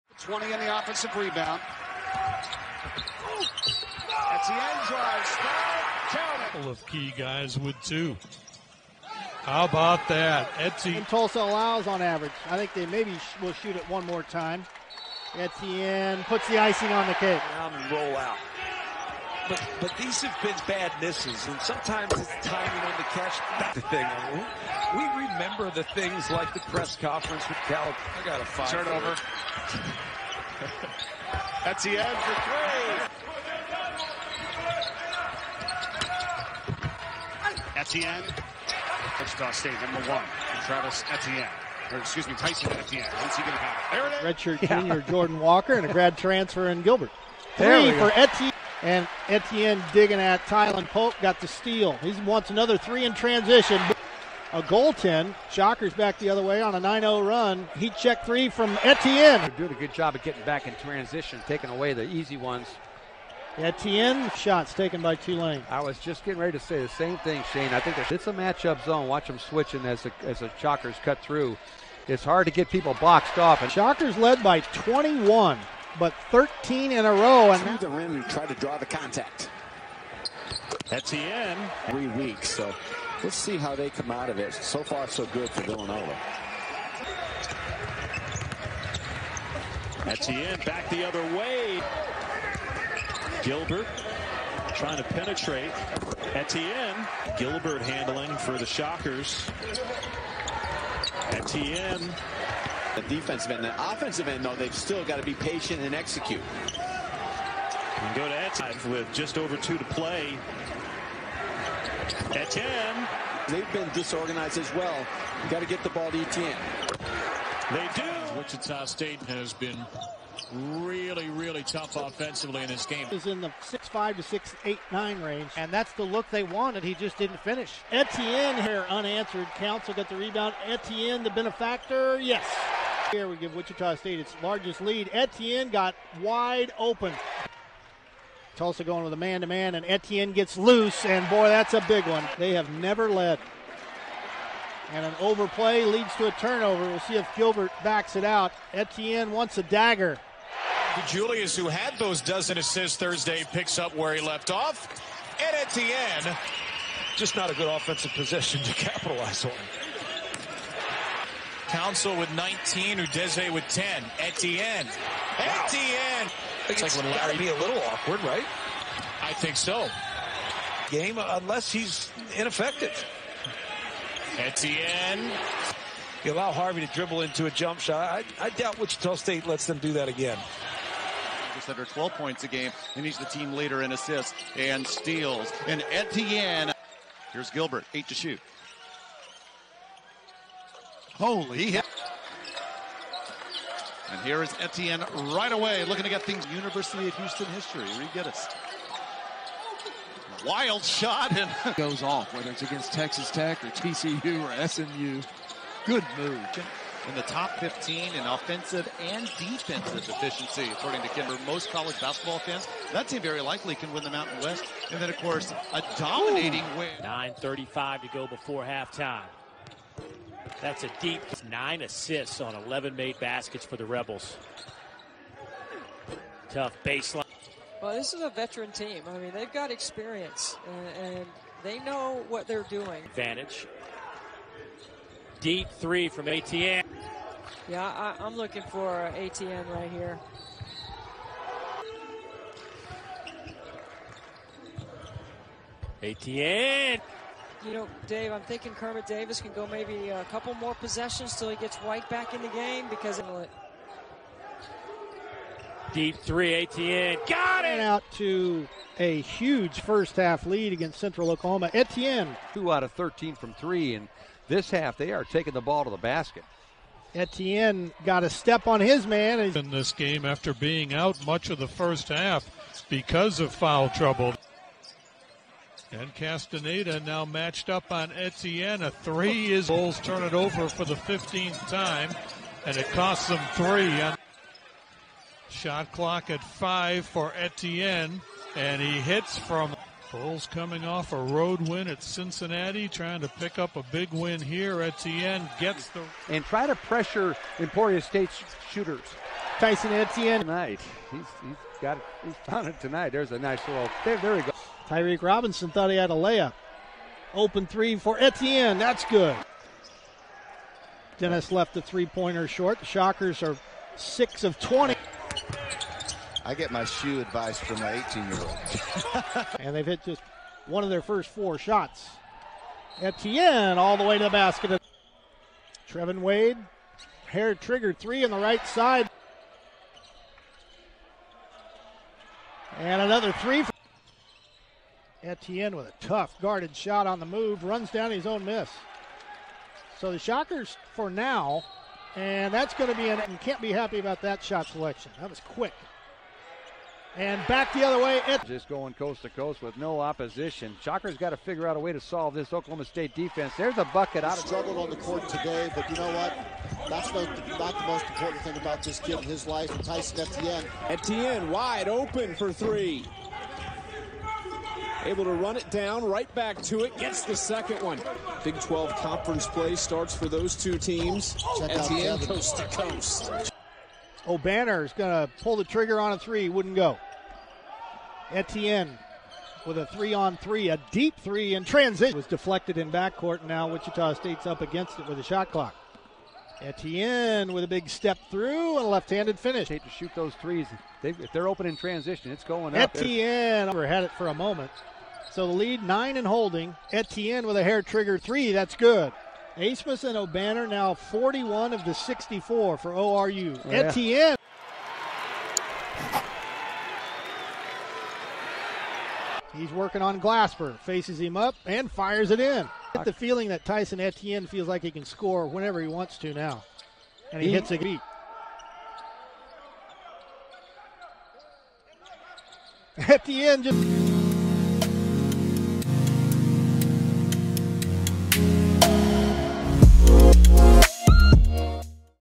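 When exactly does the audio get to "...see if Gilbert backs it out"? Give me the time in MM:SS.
02:27.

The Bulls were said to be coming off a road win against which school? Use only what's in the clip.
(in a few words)
Cincinnati.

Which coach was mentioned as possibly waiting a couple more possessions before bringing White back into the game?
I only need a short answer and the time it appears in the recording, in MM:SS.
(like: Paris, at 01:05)
Kermit Davis, at 04:08.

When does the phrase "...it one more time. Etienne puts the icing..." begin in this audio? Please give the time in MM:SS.
00:13.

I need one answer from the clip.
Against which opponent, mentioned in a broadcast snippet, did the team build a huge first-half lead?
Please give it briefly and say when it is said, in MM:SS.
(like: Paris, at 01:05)
Central Oklahoma, at 04:20.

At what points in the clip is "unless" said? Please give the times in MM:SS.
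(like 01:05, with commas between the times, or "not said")
02:51.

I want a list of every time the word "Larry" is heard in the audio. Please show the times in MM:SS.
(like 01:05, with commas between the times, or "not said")
02:47.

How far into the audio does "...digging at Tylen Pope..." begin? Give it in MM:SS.
00:49.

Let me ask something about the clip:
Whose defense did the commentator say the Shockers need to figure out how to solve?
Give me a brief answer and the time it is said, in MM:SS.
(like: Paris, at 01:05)
Oklahoma State, at 05:52.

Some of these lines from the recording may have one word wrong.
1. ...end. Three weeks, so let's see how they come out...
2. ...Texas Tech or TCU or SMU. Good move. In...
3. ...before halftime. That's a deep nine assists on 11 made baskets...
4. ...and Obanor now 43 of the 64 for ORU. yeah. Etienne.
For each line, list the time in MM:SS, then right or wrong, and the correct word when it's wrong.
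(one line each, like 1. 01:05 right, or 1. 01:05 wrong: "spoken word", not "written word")
1. 01:21 right
2. 03:22 right
3. 03:38 right
4. 06:40 wrong: "41", not "43".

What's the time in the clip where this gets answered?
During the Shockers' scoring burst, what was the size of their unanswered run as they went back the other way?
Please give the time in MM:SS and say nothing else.
00:56.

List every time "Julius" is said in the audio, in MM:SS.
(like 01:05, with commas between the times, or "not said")
02:31.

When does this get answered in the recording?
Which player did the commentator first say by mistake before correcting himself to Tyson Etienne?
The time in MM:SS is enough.
00:40.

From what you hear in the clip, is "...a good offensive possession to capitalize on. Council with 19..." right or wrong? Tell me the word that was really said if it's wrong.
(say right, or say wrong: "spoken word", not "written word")
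right.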